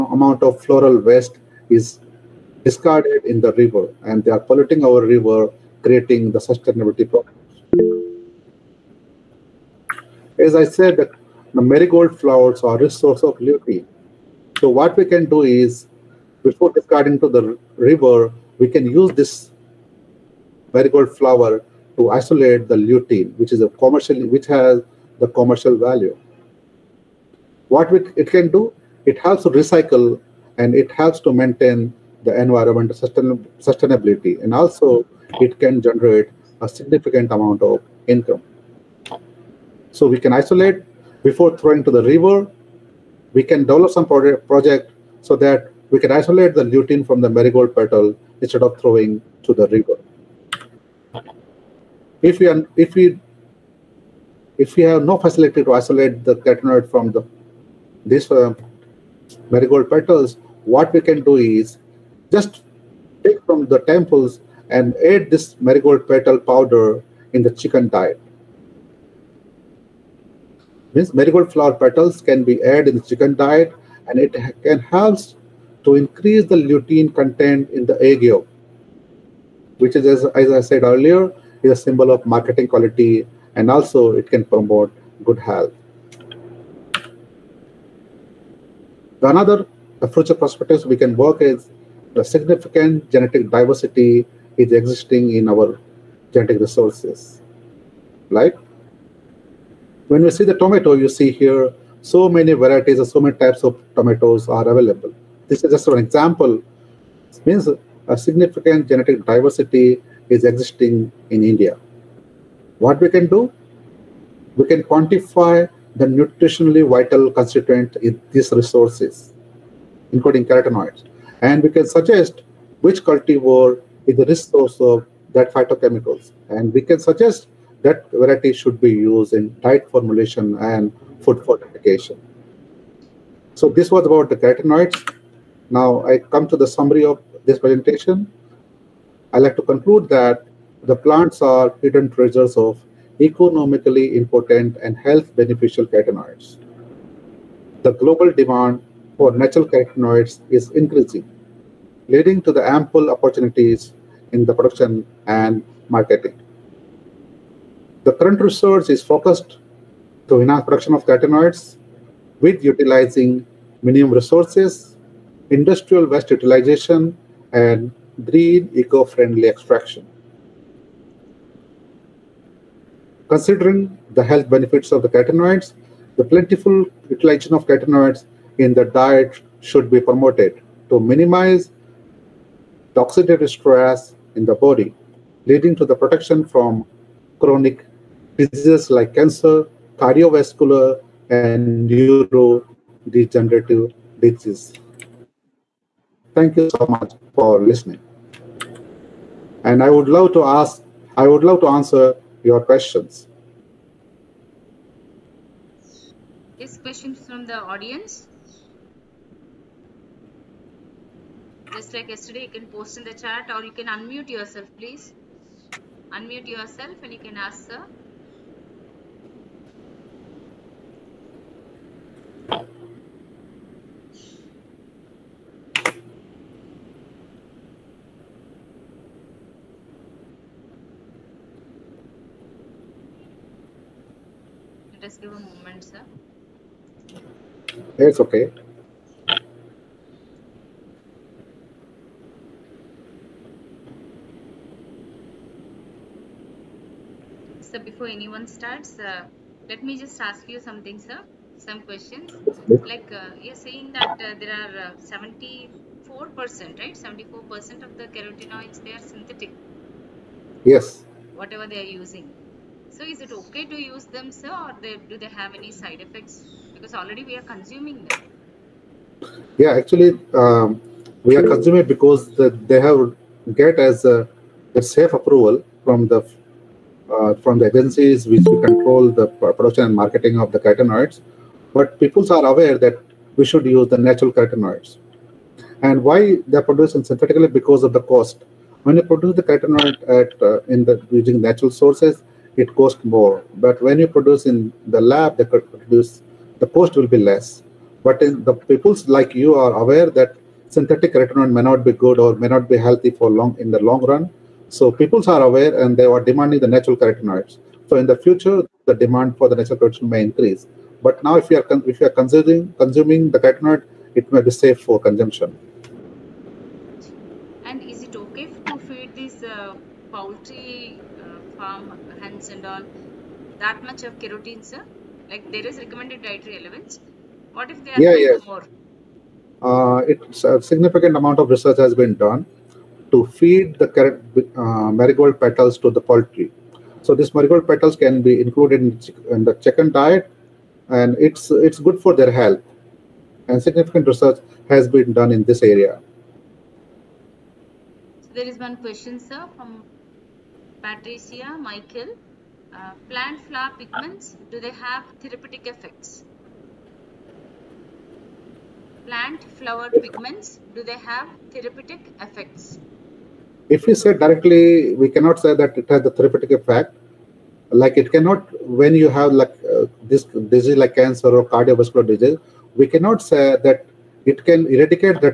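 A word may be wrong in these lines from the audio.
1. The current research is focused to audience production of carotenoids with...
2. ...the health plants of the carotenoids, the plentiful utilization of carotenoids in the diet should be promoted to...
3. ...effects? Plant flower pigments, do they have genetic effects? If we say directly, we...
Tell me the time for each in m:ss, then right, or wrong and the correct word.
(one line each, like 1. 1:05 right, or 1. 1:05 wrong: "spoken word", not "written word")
1. 2:38 wrong: "enhance", not "audience"
2. 2:54 wrong: "benefits", not "plants"
3. 5:55 wrong: "therapeutic", not "genetic".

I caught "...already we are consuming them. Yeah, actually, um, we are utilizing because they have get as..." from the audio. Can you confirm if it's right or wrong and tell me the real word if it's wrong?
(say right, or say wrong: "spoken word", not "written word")
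wrong: "consuming", not "utilizing".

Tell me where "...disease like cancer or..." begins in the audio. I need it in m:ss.
6:10.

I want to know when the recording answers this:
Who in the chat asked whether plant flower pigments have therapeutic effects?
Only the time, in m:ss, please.
5:50.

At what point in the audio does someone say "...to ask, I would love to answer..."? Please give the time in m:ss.
3:20.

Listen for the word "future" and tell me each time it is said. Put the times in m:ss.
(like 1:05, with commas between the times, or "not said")
1:30, 5:08.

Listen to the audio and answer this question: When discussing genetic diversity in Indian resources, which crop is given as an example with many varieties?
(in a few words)
Tomato.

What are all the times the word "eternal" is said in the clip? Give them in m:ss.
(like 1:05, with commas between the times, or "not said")
not said.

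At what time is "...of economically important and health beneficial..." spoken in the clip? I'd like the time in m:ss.
2:22.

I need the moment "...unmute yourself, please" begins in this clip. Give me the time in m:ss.
3:33.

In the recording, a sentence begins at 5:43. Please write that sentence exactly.
And significant research has been done in this area.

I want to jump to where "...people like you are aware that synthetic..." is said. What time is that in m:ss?
4:58.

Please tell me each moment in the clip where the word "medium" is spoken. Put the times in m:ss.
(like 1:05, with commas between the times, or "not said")
not said.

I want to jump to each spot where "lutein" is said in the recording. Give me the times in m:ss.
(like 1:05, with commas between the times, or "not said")
0:22, 0:46, 1:16.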